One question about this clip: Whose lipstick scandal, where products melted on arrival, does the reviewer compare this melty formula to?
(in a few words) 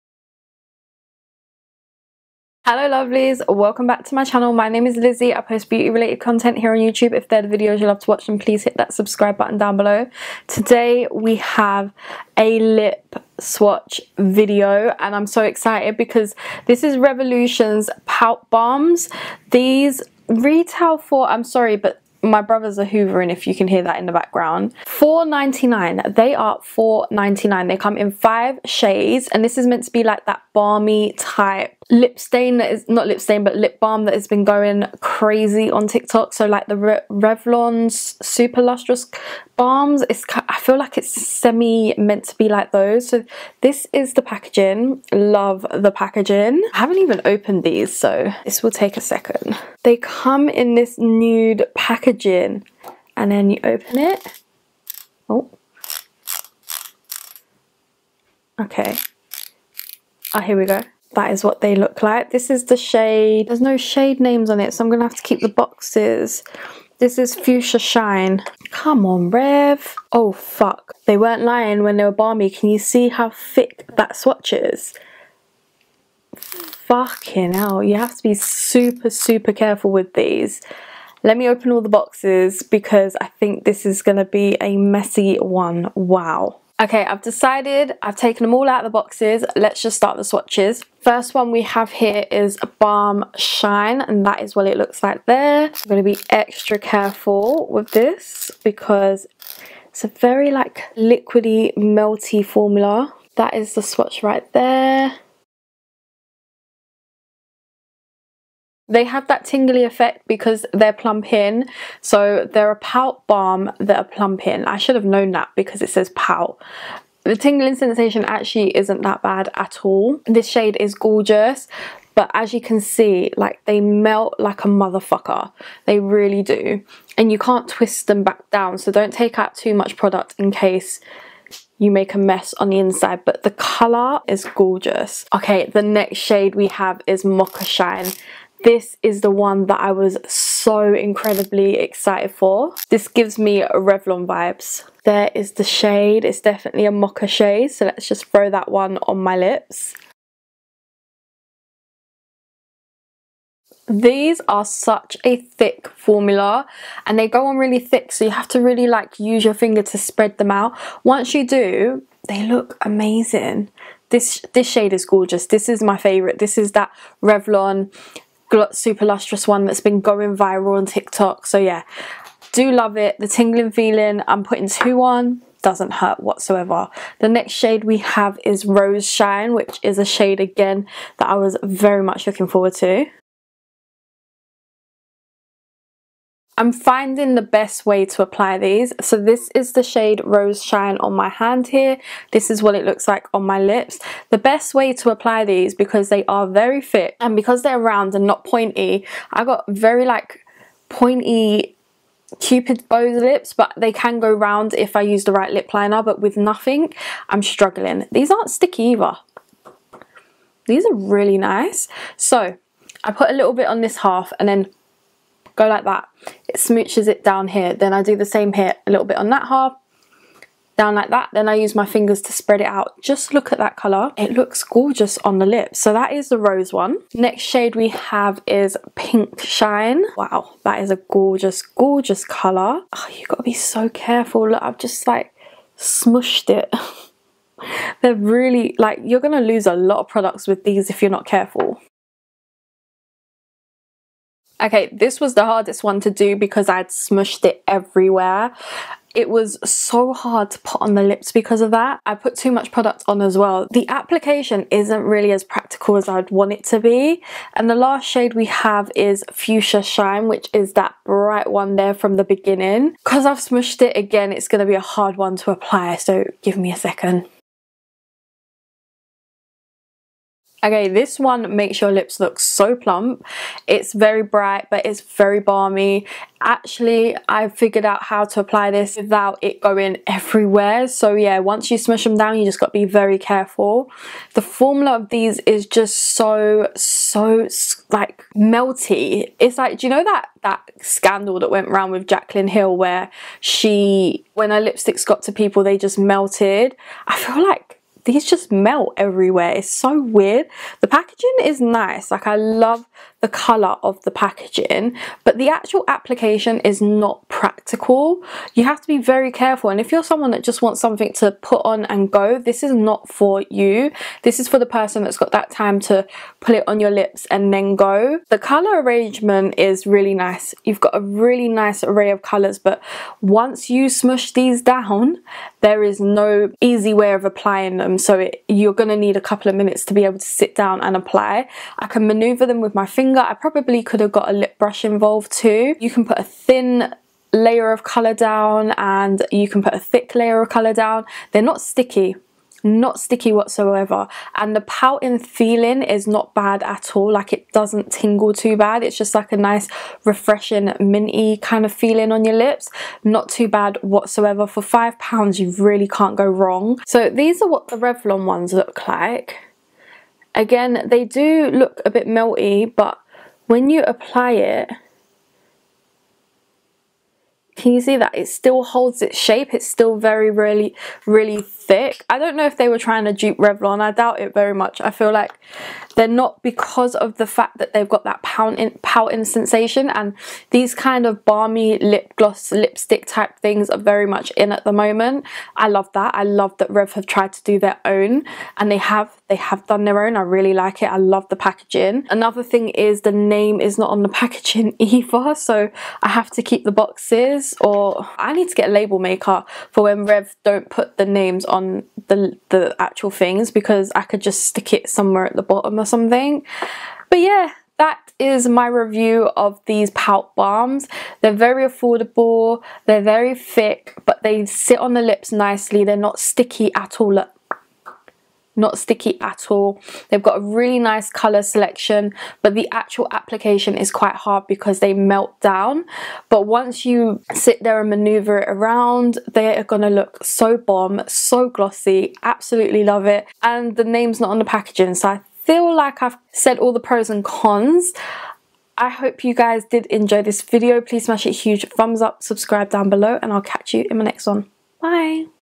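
Jaclyn Hill.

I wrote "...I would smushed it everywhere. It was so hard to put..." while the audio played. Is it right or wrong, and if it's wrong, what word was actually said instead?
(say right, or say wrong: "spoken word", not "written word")
right.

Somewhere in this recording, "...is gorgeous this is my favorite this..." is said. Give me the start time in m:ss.
2:44.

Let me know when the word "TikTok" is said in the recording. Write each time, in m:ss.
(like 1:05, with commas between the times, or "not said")
0:35, 2:50.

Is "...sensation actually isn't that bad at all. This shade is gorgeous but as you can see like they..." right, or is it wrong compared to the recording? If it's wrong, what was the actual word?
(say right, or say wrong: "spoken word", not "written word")
right.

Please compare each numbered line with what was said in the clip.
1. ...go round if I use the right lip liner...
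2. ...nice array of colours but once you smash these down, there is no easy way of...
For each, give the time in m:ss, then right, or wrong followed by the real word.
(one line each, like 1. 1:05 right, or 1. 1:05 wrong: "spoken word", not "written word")
1. 3:24 right
2. 5:21 wrong: "smush", not "smash".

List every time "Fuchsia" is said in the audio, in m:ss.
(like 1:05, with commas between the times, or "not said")
1:07, 4:19.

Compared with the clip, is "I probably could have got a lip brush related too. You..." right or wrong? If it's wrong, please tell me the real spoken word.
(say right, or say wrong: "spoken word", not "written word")
wrong: "involved", not "related".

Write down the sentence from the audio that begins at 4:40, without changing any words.
So yeah, once you smush them down, you just got to be very careful.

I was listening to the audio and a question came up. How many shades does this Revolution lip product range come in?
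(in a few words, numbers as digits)
5.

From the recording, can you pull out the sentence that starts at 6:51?
They're very affordable, they're very thick, but they sit on the lips nicely.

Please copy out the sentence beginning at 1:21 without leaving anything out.
Let me open all the boxes because I think this is going to be a messy one.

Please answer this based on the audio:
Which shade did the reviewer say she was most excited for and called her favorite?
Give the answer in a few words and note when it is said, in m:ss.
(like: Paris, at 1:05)
Mocha Shine, at 2:17.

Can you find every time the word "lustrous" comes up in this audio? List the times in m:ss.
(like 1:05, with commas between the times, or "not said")
0:38, 2:49.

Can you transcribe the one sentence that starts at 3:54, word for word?
Look, I've just like smushed it.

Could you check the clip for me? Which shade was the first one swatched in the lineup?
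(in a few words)
Balm Shine.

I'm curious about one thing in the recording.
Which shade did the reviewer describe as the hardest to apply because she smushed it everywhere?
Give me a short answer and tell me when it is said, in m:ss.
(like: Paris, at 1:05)
Pink Shine, at 3:48.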